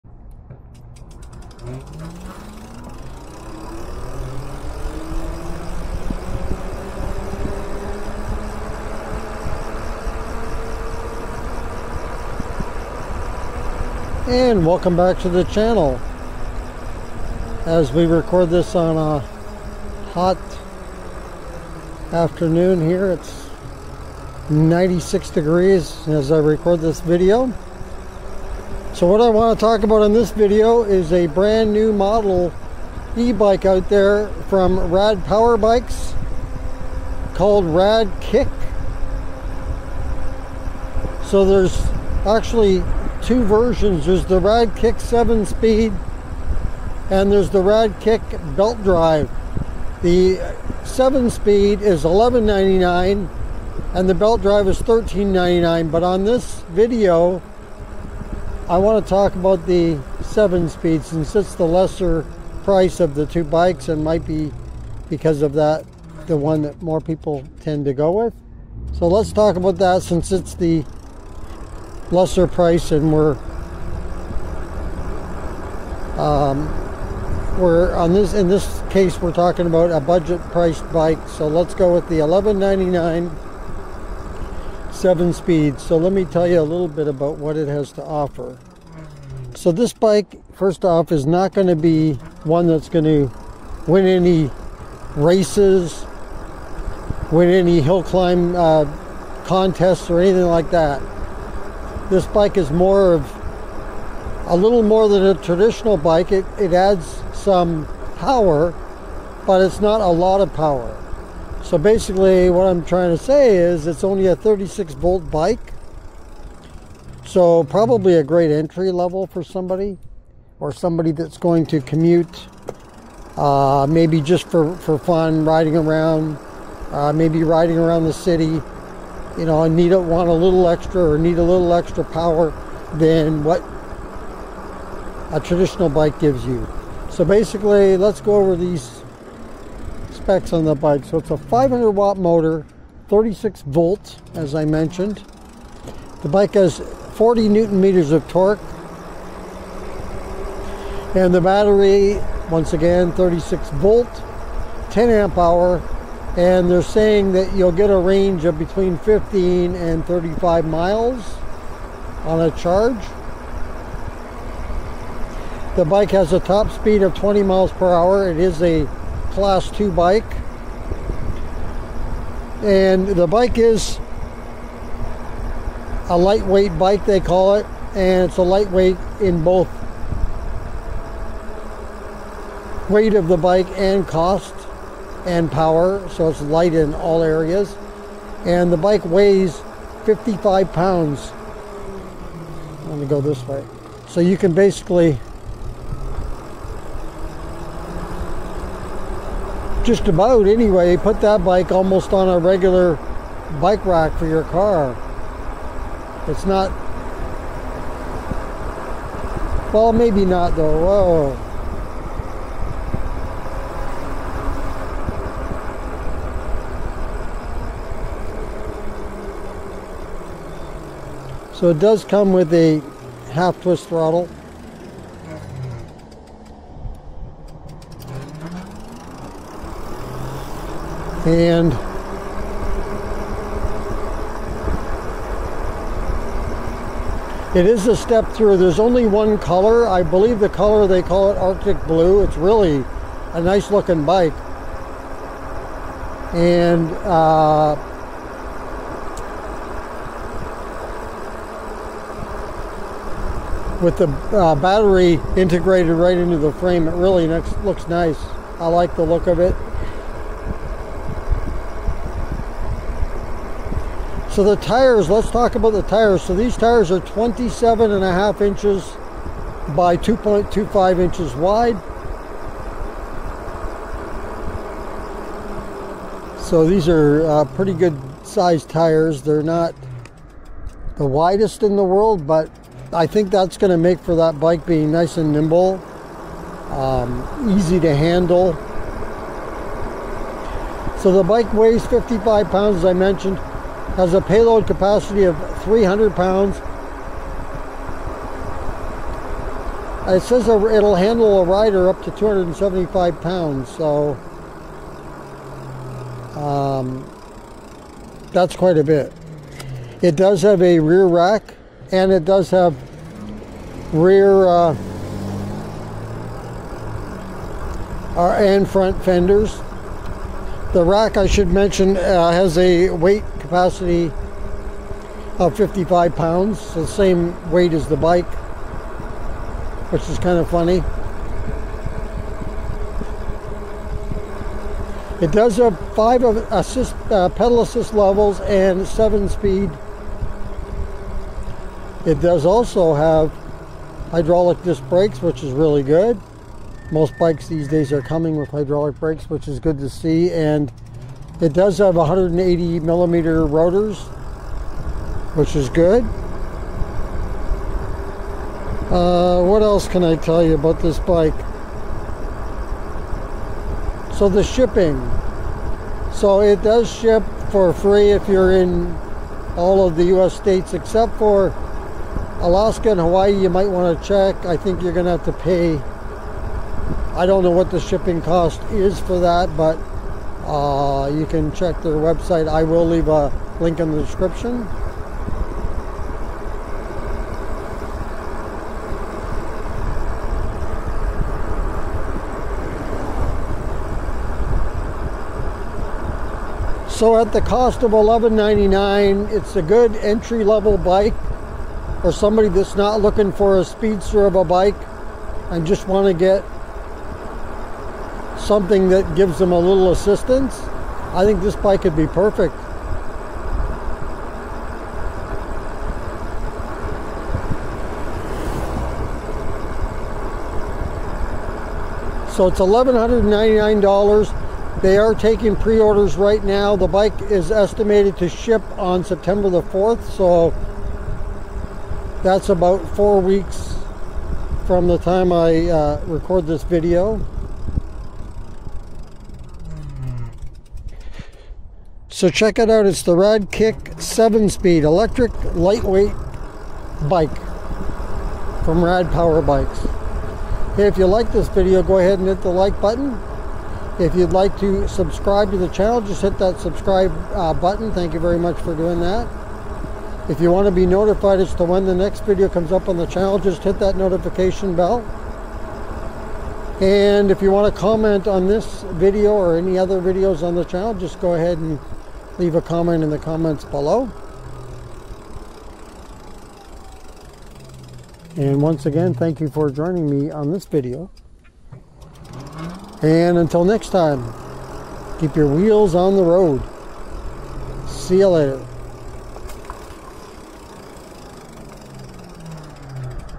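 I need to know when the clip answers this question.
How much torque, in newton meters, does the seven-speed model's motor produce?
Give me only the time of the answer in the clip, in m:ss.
2:27.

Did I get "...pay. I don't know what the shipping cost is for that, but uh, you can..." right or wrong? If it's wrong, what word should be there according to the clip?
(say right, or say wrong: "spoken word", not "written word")
right.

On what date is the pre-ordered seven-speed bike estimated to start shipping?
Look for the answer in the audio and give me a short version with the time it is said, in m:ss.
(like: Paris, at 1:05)
September 4, at 7:09.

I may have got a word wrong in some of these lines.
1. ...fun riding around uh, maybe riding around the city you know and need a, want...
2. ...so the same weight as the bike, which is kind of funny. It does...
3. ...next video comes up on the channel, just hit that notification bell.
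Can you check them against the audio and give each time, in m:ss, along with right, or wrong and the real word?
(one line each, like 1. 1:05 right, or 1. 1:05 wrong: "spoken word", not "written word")
1. 2:04 right
2. 5:26 right
3. 7:41 right.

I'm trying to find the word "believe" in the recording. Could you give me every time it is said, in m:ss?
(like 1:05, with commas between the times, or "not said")
4:00.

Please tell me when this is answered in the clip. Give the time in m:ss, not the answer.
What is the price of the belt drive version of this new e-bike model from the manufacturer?
0:54.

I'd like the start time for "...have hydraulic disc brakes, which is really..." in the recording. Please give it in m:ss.
5:42.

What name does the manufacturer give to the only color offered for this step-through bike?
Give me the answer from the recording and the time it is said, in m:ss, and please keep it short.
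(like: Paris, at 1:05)
Arctic blue, at 4:01.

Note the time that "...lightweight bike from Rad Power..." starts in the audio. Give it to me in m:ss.
7:25.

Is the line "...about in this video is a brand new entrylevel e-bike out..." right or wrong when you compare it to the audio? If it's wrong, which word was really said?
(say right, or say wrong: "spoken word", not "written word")
wrong: "model", not "entrylevel".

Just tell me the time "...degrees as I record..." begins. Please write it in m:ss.
0:25.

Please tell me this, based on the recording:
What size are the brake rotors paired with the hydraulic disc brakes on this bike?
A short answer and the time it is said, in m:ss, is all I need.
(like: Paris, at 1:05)
180 millimeter, at 5:51.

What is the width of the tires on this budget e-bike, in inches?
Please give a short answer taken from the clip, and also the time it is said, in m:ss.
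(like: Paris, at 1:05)
2.25 inches, at 4:29.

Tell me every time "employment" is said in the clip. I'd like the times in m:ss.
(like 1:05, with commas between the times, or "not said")
not said.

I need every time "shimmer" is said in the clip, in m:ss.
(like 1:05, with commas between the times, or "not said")
not said.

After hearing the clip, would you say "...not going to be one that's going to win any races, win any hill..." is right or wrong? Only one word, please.
right.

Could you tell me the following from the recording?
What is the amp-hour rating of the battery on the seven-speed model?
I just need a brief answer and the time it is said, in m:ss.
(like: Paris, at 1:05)
10 amp hour, at 2:34.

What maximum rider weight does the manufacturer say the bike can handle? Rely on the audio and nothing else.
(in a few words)
275 pounds.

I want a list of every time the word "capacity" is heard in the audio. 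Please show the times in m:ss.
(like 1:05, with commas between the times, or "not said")
4:54, 5:23.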